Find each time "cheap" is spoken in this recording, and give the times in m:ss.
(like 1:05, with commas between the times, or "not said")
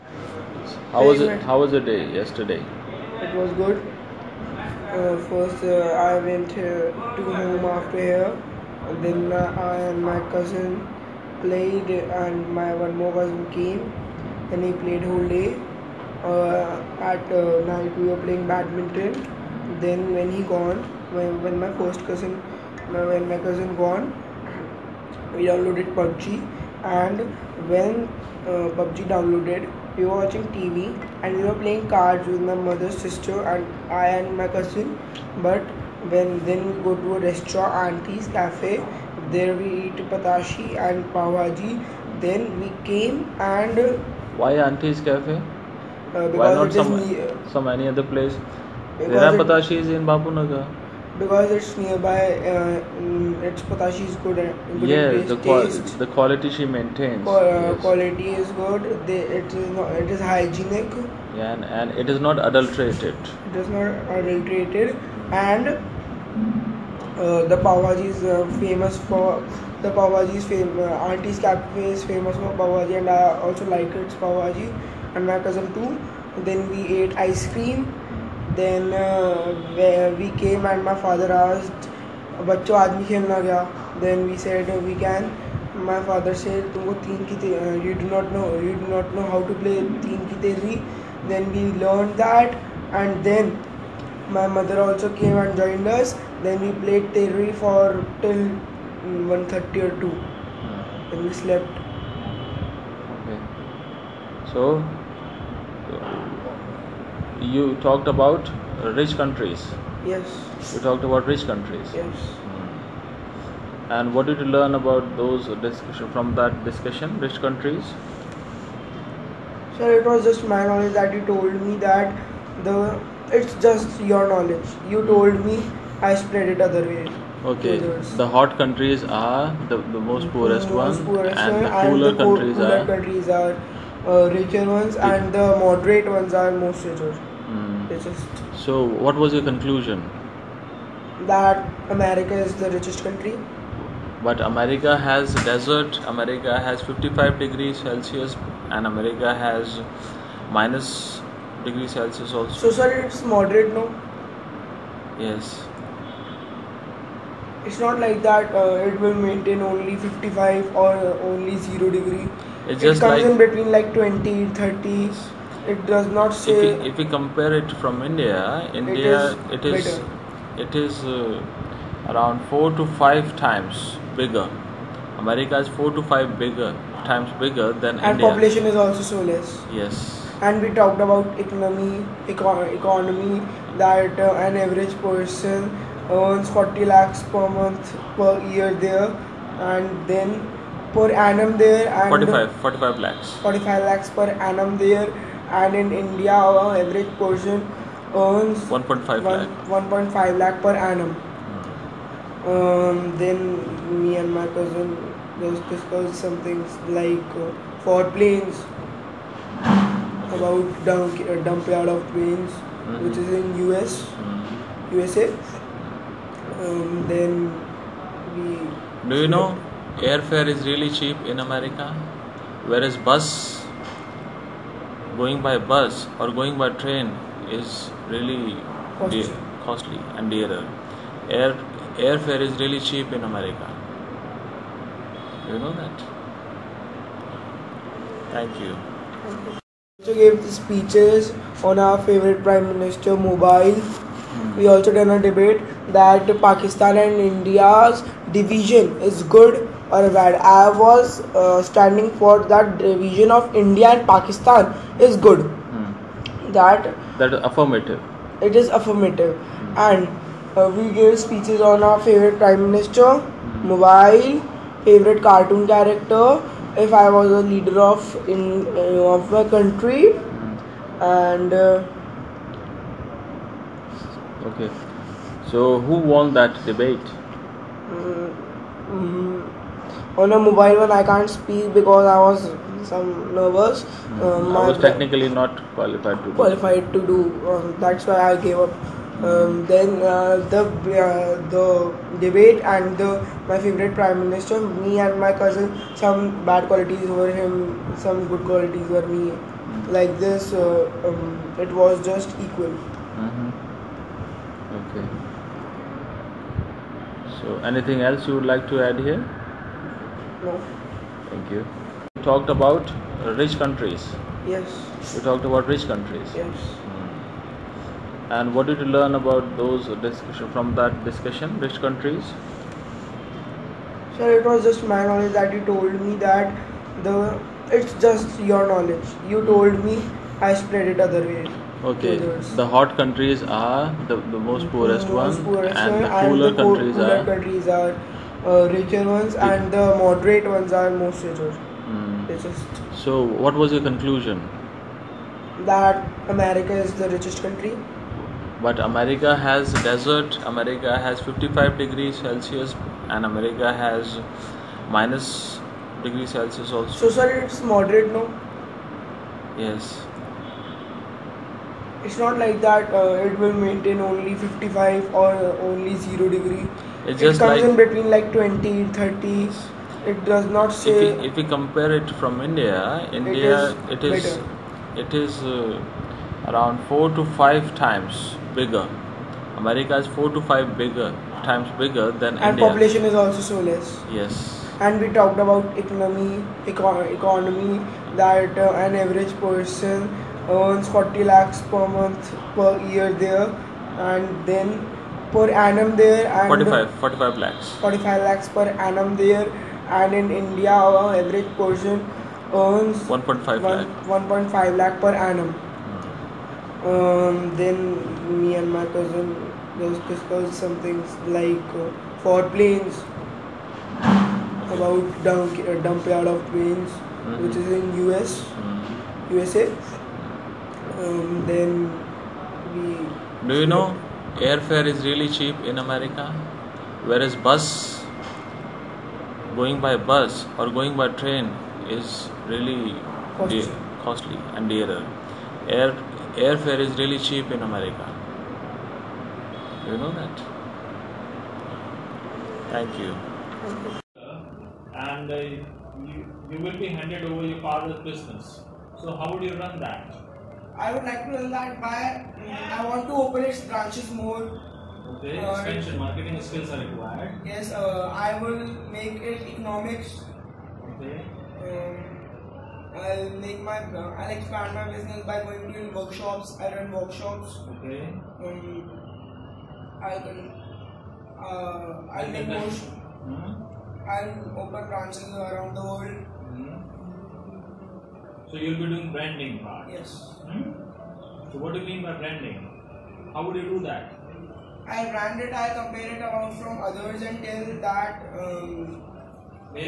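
3:40, 3:52, 7:05, 7:17.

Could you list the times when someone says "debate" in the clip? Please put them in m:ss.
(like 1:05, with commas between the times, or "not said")
4:05, 4:36, 4:52.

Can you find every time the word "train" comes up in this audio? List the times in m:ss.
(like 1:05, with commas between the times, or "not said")
3:46, 7:11.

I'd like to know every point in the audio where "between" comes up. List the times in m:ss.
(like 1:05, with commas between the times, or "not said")
2:43, 6:07.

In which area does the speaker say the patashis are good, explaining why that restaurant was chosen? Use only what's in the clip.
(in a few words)
Bapunagar.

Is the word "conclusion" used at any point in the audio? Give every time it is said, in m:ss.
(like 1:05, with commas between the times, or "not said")
2:19, 5:43.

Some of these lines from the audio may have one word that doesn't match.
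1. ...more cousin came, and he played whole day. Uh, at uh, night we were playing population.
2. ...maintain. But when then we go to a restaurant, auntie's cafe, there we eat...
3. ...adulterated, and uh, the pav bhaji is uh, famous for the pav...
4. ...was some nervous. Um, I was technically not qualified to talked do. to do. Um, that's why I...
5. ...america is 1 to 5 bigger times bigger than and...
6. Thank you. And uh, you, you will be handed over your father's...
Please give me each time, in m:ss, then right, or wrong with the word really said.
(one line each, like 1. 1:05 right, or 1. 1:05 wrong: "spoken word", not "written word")
1. 0:12 wrong: "badminton", not "population"
2. 0:34 wrong: "cousin", not "maintain"
3. 1:04 right
4. 4:42 wrong: "qualified", not "talked"
5. 6:19 wrong: "4", not "1"
6. 7:23 right.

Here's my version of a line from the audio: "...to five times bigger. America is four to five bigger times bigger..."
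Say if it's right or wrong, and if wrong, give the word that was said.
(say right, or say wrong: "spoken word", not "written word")
right.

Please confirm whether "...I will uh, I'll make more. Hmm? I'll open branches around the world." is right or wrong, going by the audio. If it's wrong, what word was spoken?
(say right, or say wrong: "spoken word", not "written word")
right.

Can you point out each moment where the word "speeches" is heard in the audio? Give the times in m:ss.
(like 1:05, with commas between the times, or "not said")
4:00, 4:21.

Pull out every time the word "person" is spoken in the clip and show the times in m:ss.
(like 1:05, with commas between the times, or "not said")
3:05, 3:17, 6:29, 6:41.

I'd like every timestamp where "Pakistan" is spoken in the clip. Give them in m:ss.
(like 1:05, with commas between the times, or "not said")
4:06, 4:14.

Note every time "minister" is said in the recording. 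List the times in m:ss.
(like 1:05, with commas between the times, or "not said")
4:02, 4:22, 4:54.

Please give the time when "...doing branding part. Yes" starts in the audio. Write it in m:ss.
7:58.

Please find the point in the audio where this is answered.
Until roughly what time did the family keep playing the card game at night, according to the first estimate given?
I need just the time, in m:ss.
1:38.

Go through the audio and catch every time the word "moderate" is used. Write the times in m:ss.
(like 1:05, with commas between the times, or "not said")
2:15, 2:33, 5:40, 5:57.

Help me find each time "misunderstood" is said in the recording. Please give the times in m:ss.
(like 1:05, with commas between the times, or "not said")
not said.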